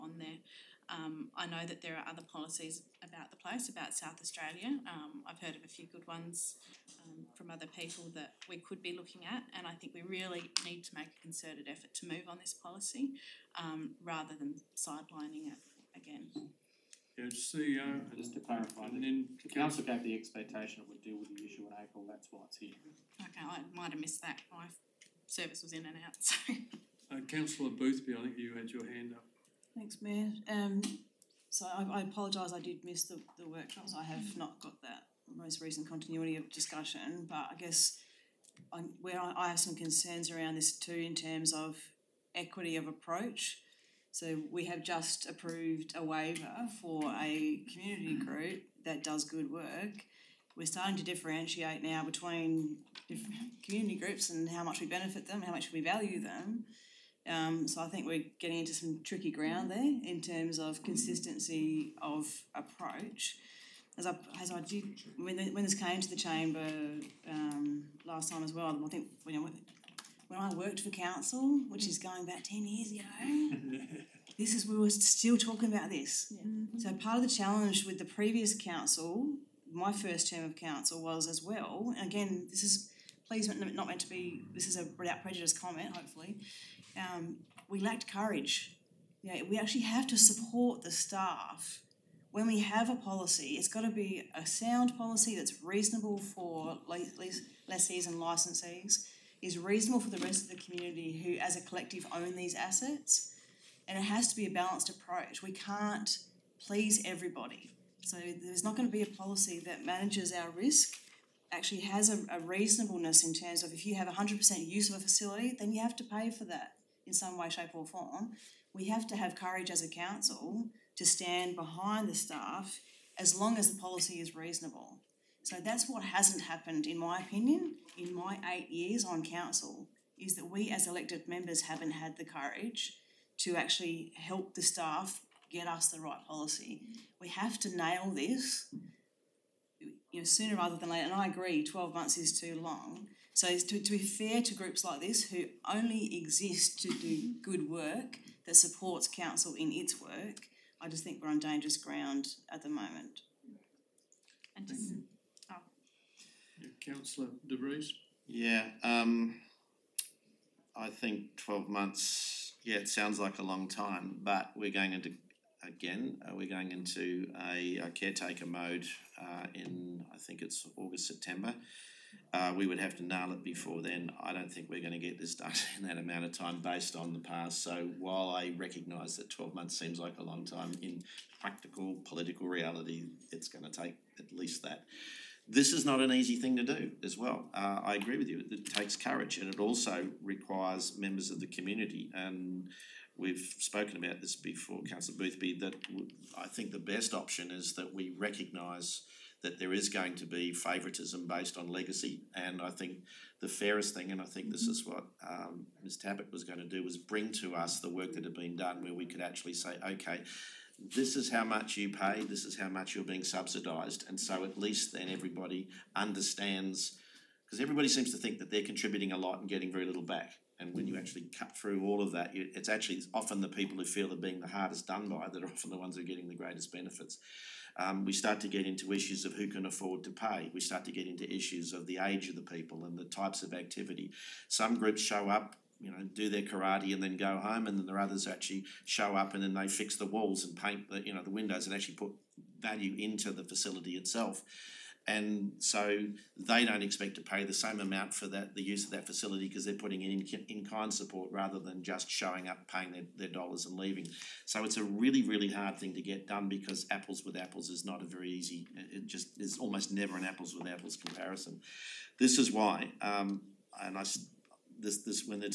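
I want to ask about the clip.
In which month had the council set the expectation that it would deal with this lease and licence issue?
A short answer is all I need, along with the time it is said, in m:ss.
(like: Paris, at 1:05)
April, at 0:21.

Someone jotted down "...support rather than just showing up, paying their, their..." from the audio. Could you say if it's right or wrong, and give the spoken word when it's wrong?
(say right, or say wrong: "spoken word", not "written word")
right.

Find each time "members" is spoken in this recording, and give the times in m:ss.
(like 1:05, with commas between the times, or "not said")
2:11, 3:10.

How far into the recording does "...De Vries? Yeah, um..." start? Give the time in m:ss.
2:37.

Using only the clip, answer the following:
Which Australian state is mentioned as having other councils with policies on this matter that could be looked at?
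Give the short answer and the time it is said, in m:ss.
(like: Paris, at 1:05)
South Australia, at 0:03.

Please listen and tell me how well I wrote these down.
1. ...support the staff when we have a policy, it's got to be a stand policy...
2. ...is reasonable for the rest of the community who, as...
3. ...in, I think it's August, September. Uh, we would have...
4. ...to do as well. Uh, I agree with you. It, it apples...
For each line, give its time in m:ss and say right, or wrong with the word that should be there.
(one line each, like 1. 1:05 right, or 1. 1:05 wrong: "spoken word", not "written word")
1. 1:30 wrong: "sound", not "stand"
2. 1:39 right
3. 2:49 right
4. 3:06 wrong: "takes", not "apples".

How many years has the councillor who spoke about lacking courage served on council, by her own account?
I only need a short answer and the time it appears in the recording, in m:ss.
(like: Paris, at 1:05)
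8, at 2:08.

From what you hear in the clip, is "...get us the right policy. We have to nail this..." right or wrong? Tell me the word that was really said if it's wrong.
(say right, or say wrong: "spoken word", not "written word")
right.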